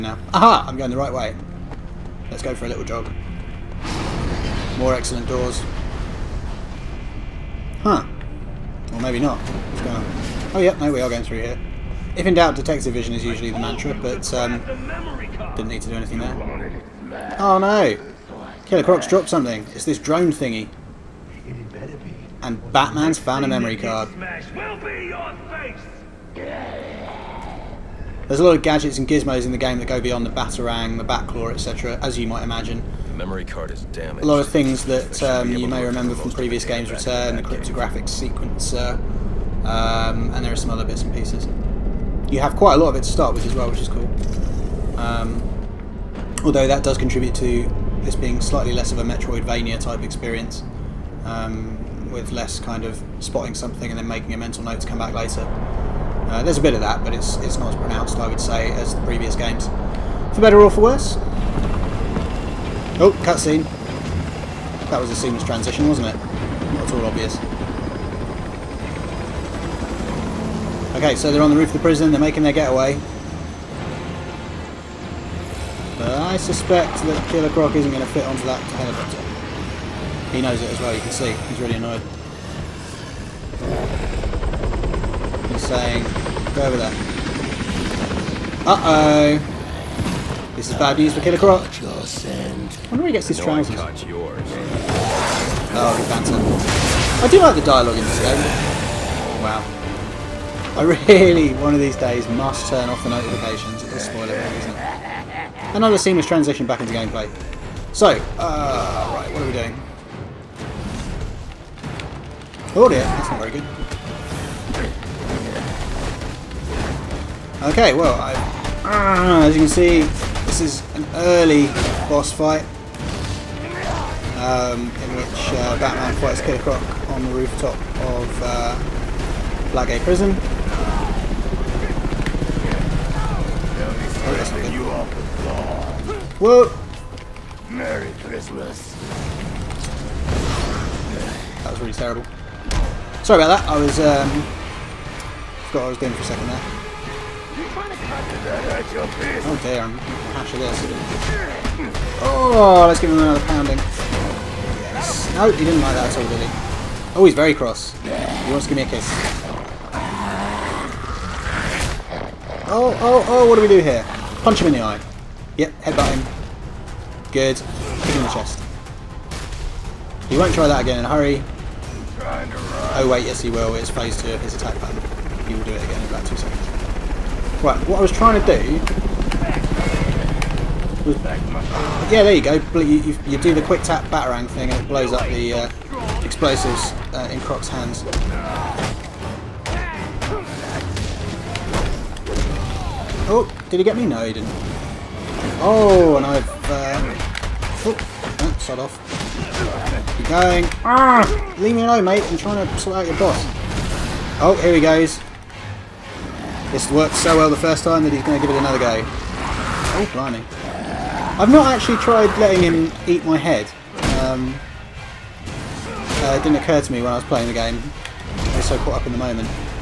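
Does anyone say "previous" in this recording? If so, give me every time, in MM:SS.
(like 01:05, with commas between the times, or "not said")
00:36, 00:59.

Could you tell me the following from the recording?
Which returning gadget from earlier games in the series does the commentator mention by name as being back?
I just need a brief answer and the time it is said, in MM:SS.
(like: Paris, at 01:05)
Cryptographic sequencer, at 00:37.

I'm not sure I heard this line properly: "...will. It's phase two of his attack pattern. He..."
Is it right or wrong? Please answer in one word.
right.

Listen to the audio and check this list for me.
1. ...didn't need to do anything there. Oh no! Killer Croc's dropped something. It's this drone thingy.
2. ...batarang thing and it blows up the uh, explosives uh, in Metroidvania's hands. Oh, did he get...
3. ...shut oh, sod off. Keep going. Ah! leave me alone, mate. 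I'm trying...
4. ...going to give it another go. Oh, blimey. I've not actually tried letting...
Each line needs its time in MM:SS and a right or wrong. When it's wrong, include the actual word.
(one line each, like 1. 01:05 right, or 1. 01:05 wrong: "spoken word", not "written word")
1. 00:15 right
2. 03:04 wrong: "Croc", not "Metroidvania"
3. 03:18 right
4. 03:28 right.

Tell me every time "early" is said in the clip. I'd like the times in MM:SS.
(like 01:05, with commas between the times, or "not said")
02:01.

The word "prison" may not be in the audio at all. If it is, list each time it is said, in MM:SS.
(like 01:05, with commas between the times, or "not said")
01:11, 02:09.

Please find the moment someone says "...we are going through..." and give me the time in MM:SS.
00:10.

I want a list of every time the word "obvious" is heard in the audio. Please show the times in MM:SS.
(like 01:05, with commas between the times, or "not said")
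01:07.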